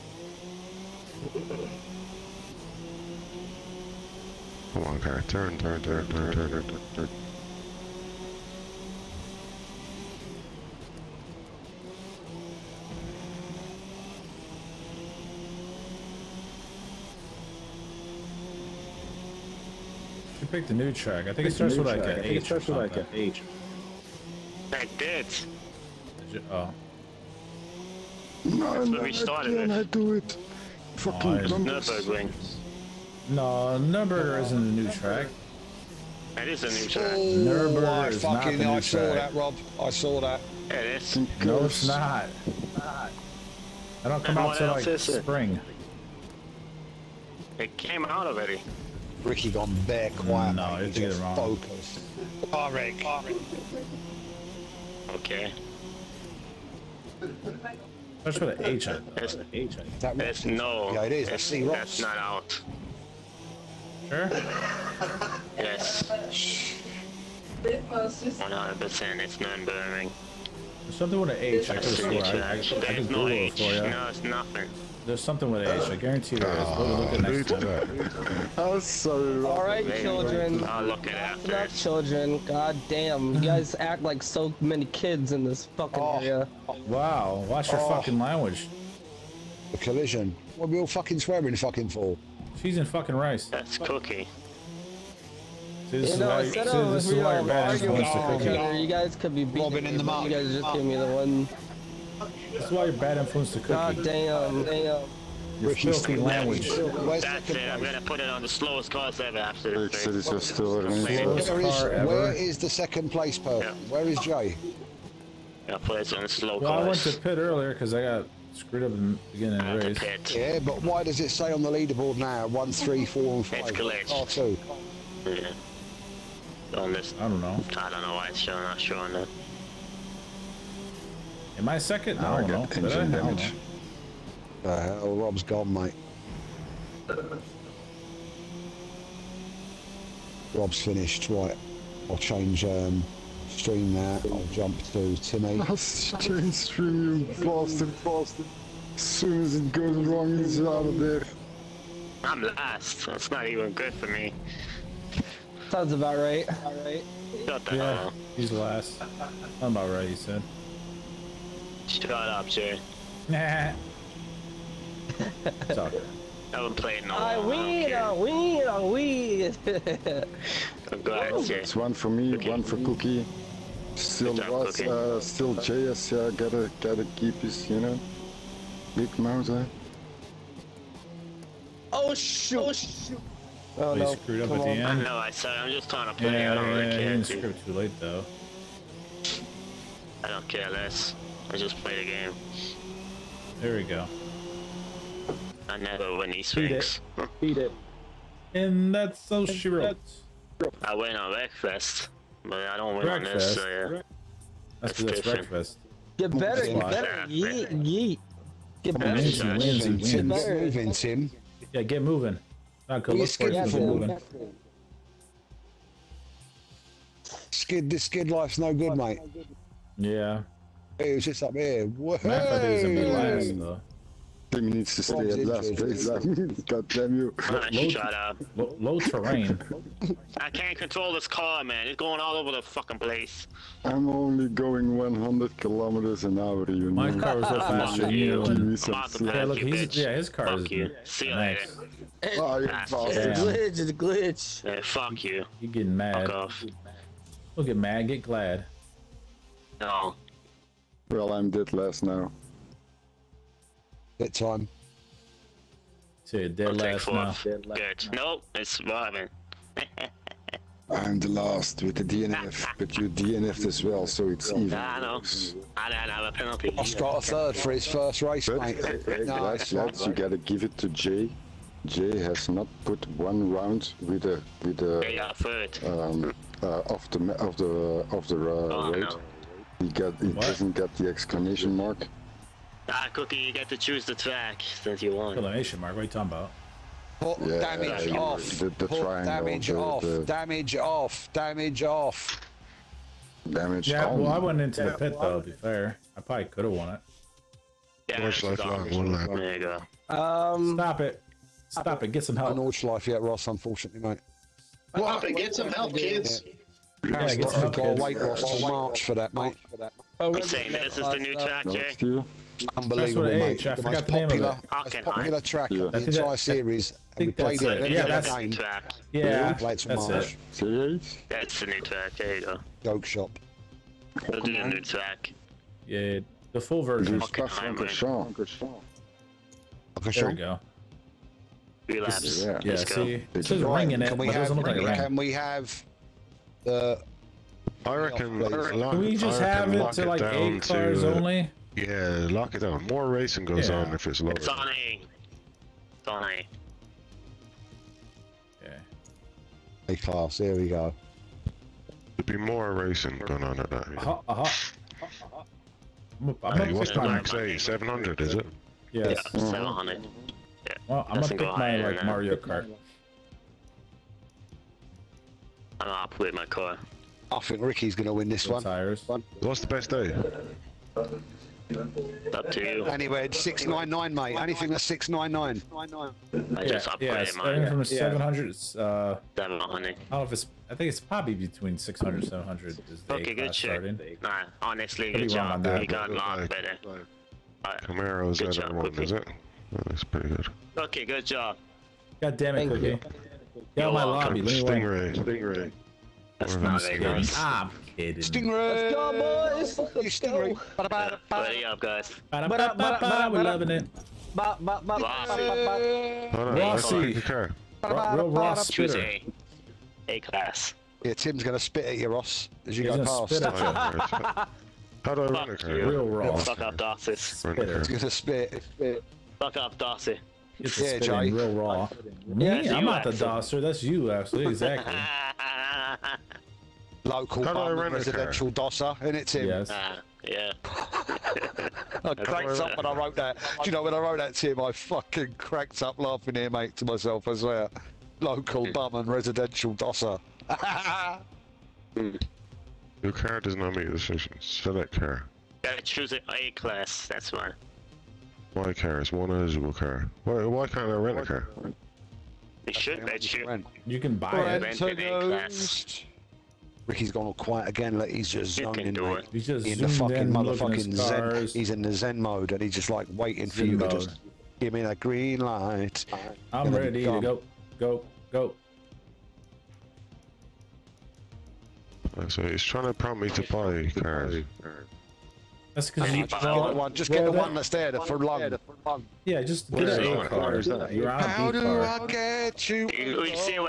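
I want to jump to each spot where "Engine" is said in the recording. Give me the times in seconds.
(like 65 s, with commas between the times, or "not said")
132 s.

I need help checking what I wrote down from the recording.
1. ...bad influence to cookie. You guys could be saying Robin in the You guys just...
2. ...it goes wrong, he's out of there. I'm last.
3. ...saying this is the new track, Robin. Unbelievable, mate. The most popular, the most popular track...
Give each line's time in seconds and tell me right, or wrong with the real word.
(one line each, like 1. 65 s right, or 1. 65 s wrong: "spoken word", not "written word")
1. 97 s wrong: "beating", not "saying"
2. 149 s right
3. 310 s wrong: "Jay", not "Robin".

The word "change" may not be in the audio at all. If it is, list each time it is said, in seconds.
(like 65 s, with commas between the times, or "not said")
142 s, 146 s.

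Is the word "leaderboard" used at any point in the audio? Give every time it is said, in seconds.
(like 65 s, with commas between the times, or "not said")
121 s.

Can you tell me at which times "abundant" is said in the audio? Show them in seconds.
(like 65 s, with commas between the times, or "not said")
not said.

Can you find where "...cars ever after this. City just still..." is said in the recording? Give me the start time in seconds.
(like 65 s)
108 s.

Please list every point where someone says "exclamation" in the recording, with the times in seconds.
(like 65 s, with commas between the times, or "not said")
281 s, 285 s.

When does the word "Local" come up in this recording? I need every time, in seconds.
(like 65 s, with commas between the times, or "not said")
427 s, 438 s.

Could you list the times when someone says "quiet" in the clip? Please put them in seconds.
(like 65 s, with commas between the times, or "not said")
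50 s, 457 s.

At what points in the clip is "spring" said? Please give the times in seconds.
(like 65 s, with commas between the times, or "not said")
44 s.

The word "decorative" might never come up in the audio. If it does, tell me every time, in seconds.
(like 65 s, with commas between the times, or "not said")
not said.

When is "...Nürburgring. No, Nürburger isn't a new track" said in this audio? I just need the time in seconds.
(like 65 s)
31 s.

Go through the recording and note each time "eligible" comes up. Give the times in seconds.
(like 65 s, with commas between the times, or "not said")
449 s.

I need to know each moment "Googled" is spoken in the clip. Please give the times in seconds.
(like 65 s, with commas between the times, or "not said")
72 s.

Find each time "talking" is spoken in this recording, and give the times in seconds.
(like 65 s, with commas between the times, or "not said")
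286 s.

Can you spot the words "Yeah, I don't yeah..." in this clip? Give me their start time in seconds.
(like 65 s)
186 s.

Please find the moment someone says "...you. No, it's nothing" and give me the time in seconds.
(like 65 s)
73 s.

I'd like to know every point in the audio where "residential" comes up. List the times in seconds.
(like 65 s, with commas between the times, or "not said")
427 s, 439 s.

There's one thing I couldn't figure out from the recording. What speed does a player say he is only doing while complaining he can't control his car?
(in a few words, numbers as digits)
100 kilometers an hour.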